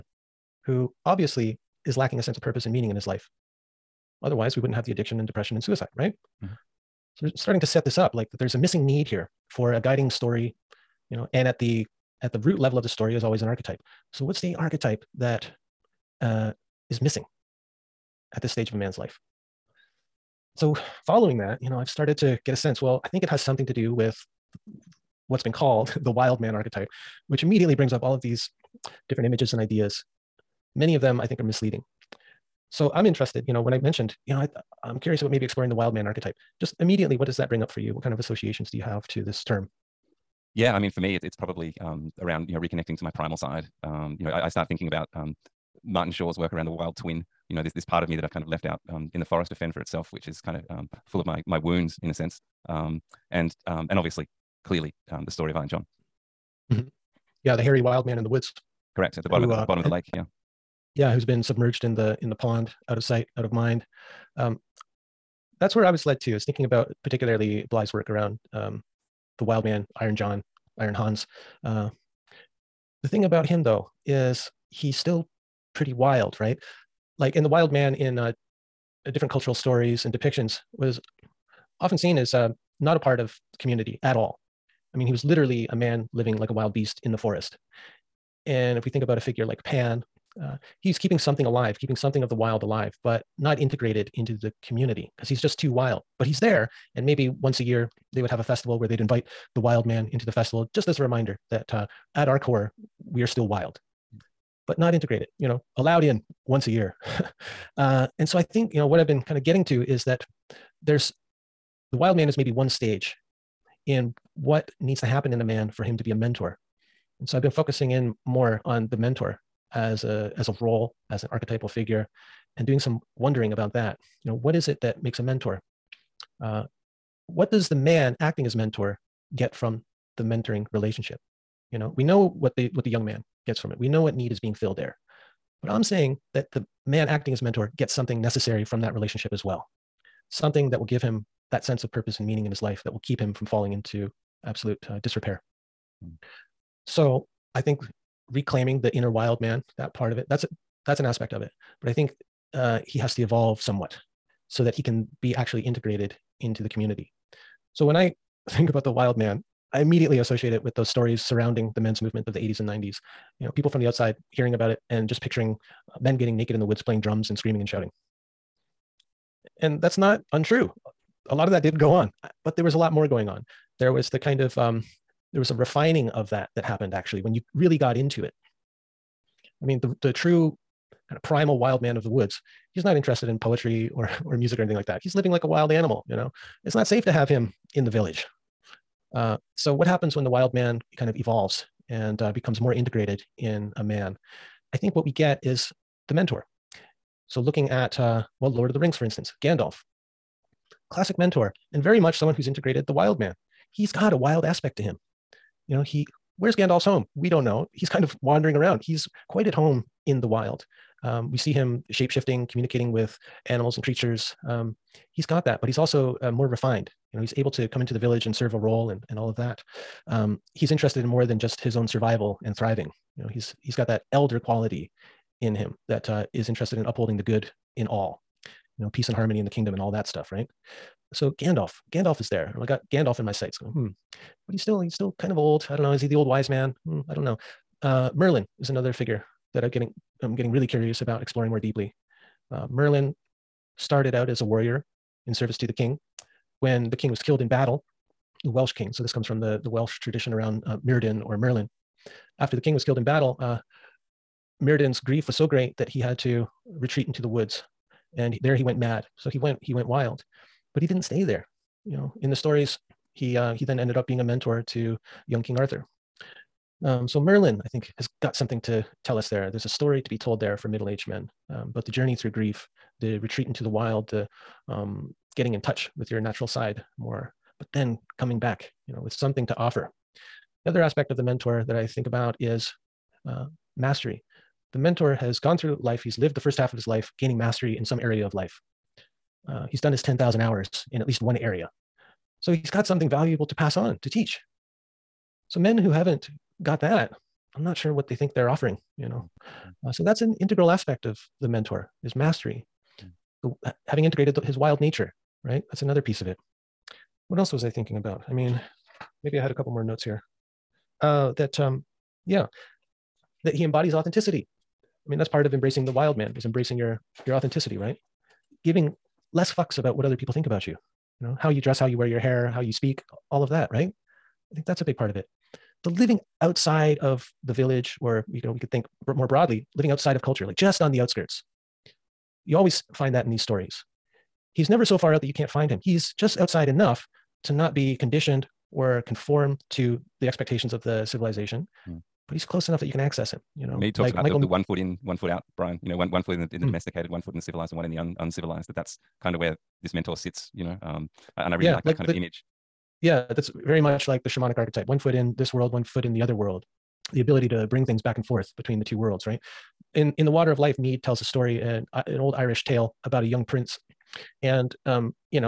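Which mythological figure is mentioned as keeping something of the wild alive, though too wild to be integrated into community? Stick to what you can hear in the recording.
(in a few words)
Pan.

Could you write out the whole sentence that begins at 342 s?
but he's close enough that you can access him.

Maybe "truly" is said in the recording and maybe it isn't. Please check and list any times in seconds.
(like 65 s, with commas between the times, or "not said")
not said.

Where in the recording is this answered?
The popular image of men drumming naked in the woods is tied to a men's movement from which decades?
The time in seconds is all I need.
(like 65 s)
162 s.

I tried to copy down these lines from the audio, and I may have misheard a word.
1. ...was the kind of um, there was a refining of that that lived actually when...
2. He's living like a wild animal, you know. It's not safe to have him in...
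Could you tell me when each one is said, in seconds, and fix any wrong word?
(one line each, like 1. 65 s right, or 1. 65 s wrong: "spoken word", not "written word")
1. 173 s wrong: "happened", not "lived"
2. 185 s right.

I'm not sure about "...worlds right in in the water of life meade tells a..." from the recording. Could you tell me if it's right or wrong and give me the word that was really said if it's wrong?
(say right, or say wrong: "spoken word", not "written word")
right.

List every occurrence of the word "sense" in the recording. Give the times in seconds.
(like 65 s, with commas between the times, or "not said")
2 s, 22 s, 52 s, 141 s.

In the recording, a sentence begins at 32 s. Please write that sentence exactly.
So I'm interested, you know, when I mentioned, you know, I, I'm curious about maybe exploring the wild man archetype.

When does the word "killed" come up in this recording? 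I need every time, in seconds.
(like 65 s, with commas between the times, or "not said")
247 s, 252 s.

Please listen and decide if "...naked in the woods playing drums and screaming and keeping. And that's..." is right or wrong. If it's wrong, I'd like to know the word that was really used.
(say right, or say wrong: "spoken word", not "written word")
wrong: "shouting", not "keeping".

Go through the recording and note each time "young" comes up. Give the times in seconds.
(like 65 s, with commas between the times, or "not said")
132 s, 265 s, 363 s.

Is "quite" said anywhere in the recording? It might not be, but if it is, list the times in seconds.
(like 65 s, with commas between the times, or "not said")
209 s.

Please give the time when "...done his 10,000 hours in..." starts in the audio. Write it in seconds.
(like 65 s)
289 s.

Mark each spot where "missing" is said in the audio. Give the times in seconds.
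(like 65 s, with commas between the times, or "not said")
8 s, 17 s.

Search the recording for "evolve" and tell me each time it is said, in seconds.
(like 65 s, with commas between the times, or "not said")
153 s, 191 s.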